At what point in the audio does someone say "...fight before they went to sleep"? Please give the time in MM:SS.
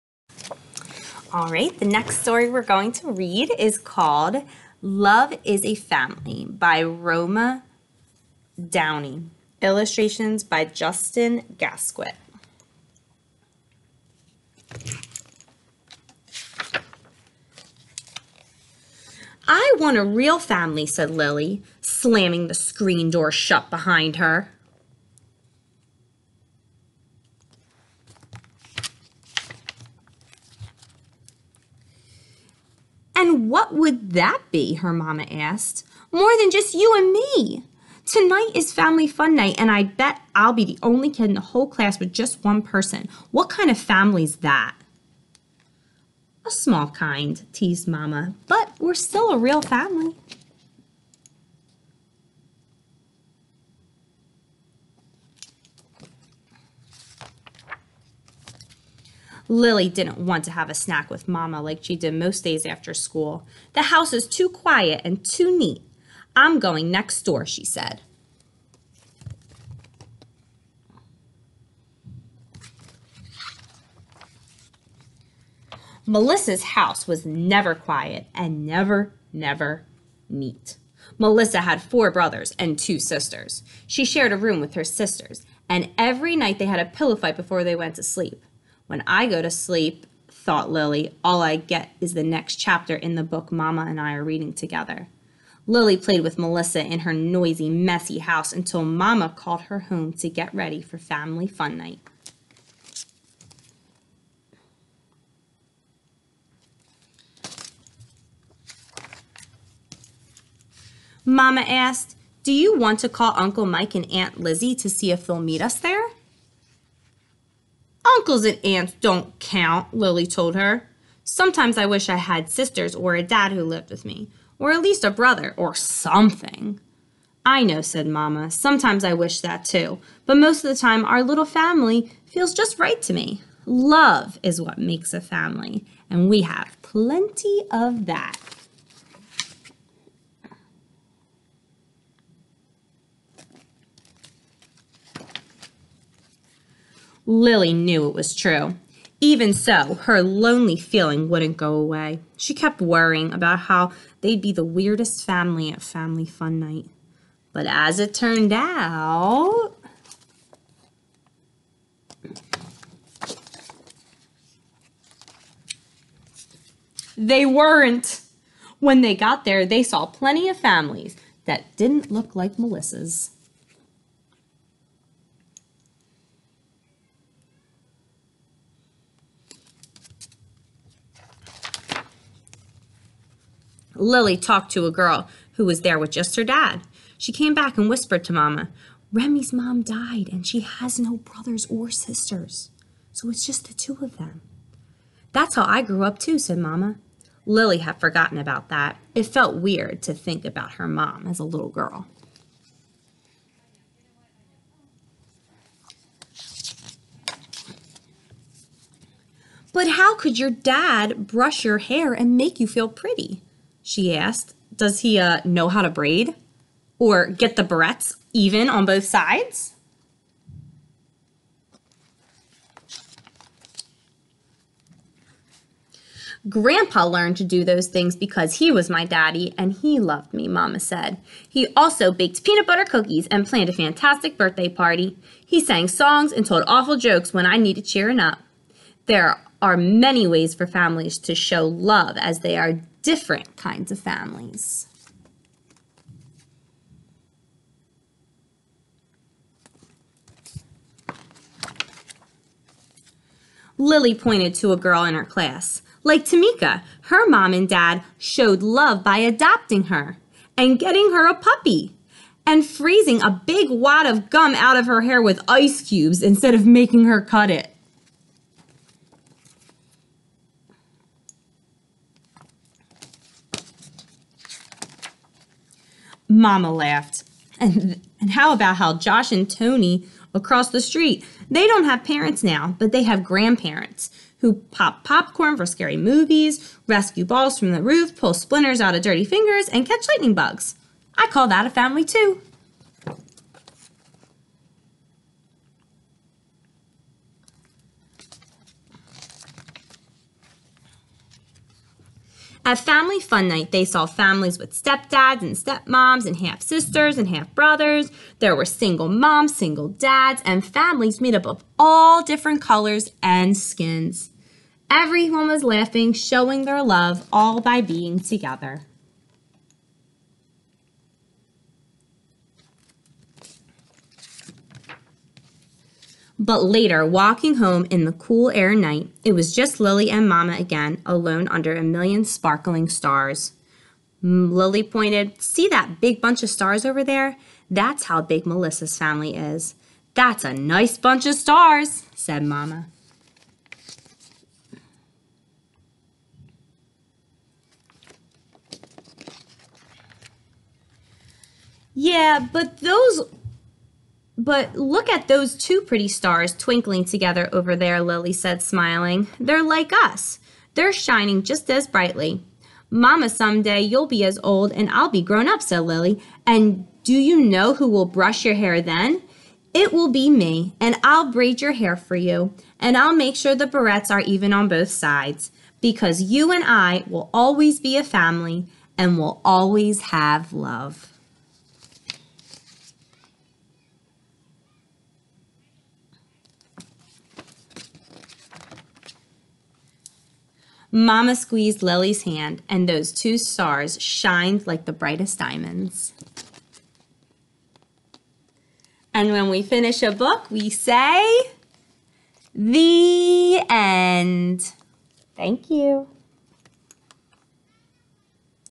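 01:27.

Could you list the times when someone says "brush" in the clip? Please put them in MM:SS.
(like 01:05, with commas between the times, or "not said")
03:31, 06:08.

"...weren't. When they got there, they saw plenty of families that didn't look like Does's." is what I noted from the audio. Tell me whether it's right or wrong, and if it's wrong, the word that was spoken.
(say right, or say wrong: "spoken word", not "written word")
wrong: "Melissa", not "Does".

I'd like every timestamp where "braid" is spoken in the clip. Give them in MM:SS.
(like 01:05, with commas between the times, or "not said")
03:35, 06:11.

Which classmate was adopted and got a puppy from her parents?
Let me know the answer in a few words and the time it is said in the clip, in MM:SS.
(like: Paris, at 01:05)
Tamika, at 04:16.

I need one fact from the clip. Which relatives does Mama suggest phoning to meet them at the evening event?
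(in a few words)
Uncle Mike and Aunt Lizzie.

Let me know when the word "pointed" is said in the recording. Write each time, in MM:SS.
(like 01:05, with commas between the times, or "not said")
04:14, 05:34.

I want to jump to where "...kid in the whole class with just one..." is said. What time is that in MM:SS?
00:41.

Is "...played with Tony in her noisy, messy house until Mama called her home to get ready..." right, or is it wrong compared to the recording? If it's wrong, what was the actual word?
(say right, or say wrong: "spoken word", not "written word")
wrong: "Melissa", not "Tony".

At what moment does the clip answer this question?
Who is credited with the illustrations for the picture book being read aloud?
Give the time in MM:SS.
00:10.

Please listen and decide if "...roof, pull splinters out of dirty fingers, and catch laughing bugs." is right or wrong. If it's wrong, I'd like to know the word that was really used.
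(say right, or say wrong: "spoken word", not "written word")
wrong: "lightning", not "laughing".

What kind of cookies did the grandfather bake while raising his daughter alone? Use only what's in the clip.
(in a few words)
Peanut butter.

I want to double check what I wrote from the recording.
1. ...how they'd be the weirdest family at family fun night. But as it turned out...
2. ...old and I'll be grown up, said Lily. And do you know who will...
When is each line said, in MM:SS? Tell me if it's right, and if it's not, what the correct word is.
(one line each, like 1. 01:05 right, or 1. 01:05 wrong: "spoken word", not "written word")
1. 02:33 right
2. 06:04 right.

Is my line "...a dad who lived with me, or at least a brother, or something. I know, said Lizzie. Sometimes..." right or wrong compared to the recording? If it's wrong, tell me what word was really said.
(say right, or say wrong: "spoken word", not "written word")
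wrong: "Mamma", not "Lizzie".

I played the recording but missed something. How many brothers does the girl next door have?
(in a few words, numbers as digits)
4.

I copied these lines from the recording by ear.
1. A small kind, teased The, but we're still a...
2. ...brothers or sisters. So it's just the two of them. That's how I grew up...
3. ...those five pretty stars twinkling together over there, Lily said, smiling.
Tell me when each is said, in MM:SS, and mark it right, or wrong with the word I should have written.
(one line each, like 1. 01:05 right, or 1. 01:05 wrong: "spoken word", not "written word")
1. 00:46 wrong: "Mama", not "The"
2. 03:11 right
3. 05:55 wrong: "two", not "five".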